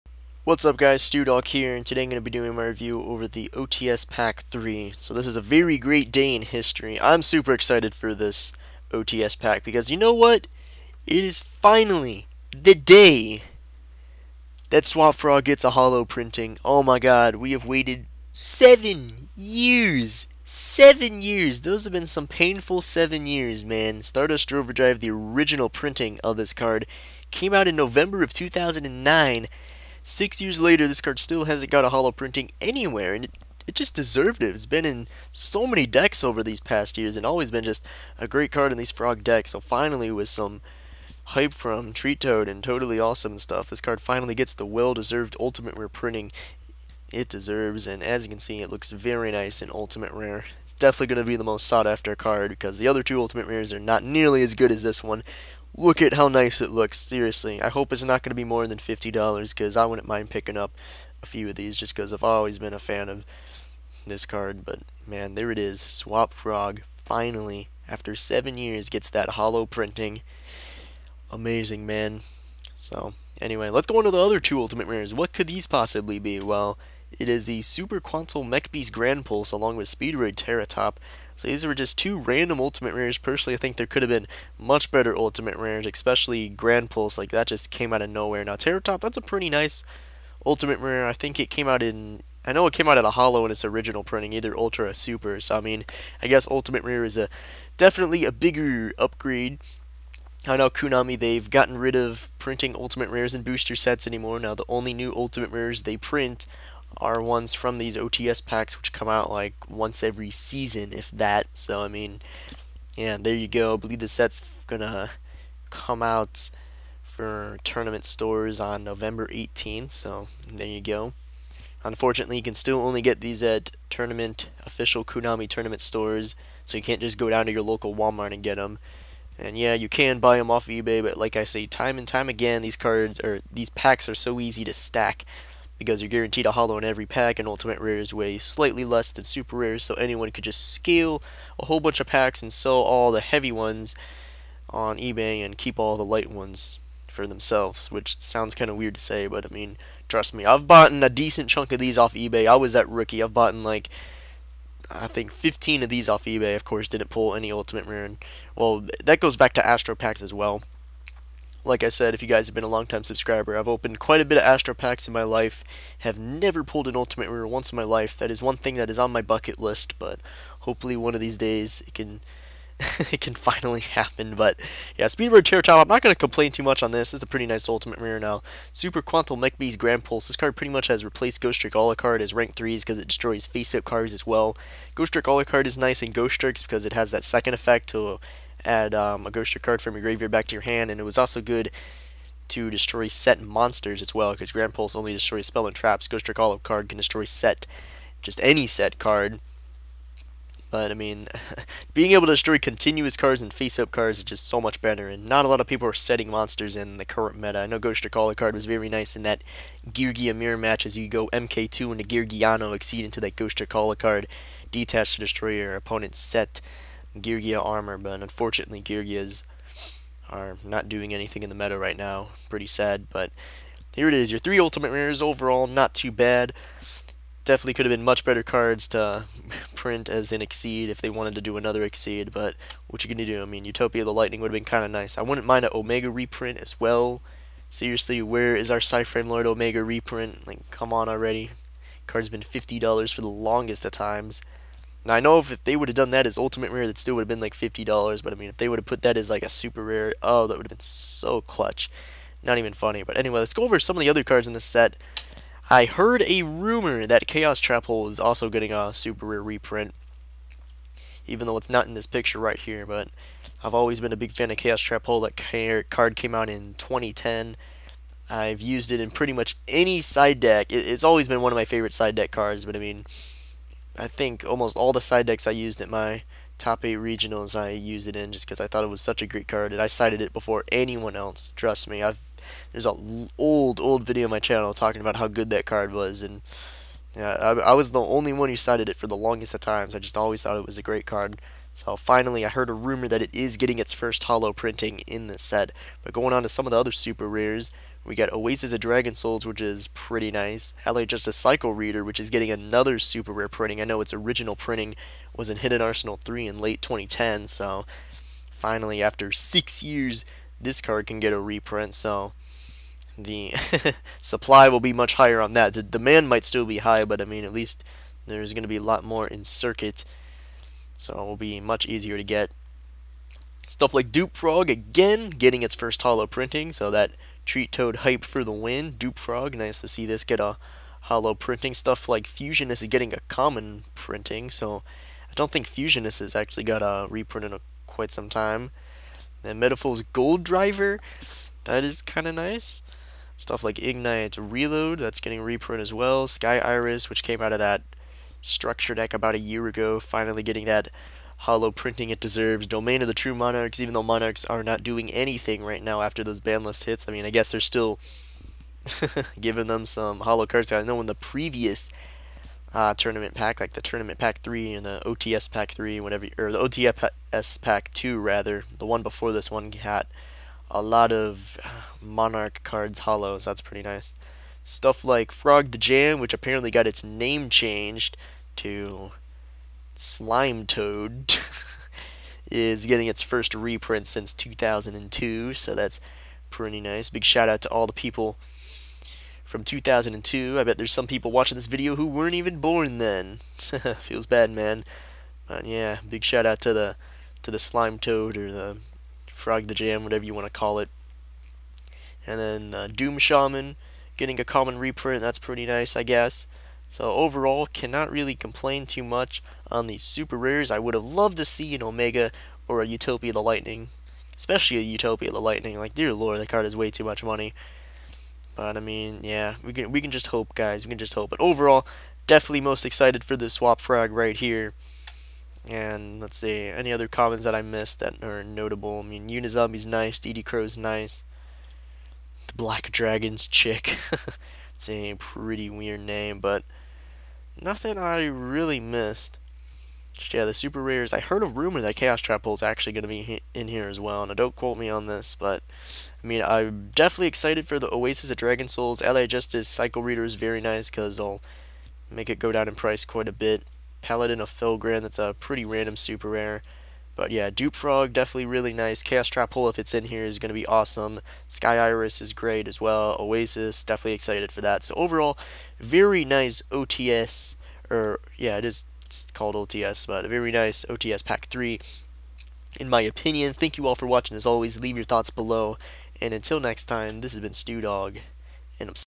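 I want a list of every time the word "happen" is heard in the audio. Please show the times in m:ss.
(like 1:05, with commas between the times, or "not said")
2:53.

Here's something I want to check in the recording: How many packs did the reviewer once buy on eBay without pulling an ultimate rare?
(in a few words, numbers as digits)
15.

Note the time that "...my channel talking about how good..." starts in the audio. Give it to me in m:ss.
4:44.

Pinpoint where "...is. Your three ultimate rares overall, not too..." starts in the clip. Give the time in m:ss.
3:44.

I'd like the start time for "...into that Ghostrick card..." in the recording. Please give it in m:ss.
3:33.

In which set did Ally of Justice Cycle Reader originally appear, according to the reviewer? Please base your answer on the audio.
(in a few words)
Hidden Arsenal 3.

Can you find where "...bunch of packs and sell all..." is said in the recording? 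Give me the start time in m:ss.
2:21.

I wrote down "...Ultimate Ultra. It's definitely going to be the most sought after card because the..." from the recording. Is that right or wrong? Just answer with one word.
wrong.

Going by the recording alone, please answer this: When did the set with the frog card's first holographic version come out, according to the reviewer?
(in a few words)
November 2009.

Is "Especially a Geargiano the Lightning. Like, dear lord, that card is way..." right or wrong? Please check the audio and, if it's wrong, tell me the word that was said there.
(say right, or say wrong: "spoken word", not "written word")
wrong: "Utopia", not "Geargiano".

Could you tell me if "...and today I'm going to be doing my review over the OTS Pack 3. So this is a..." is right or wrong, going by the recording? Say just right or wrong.
right.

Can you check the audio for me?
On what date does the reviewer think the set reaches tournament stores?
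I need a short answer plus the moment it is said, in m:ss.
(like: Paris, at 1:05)
November 18th, at 1:58.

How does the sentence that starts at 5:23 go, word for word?
Stuff like Dupe Frog, again, getting its first hollow printing, so that Treat Toad hype for the win.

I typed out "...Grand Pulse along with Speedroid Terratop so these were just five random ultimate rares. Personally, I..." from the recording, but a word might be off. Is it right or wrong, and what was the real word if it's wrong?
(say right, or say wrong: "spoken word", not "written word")
wrong: "two", not "five".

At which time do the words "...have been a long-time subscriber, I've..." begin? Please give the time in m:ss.
2:42.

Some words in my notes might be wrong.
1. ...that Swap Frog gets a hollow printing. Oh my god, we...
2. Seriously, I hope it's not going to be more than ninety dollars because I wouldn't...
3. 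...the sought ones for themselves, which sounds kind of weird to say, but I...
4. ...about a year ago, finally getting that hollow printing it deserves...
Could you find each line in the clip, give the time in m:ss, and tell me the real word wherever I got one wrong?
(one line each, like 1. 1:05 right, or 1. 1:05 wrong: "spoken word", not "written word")
1. 0:14 right
2. 0:56 wrong: "fifty", not "ninety"
3. 2:25 wrong: "light", not "sought"
4. 5:49 right.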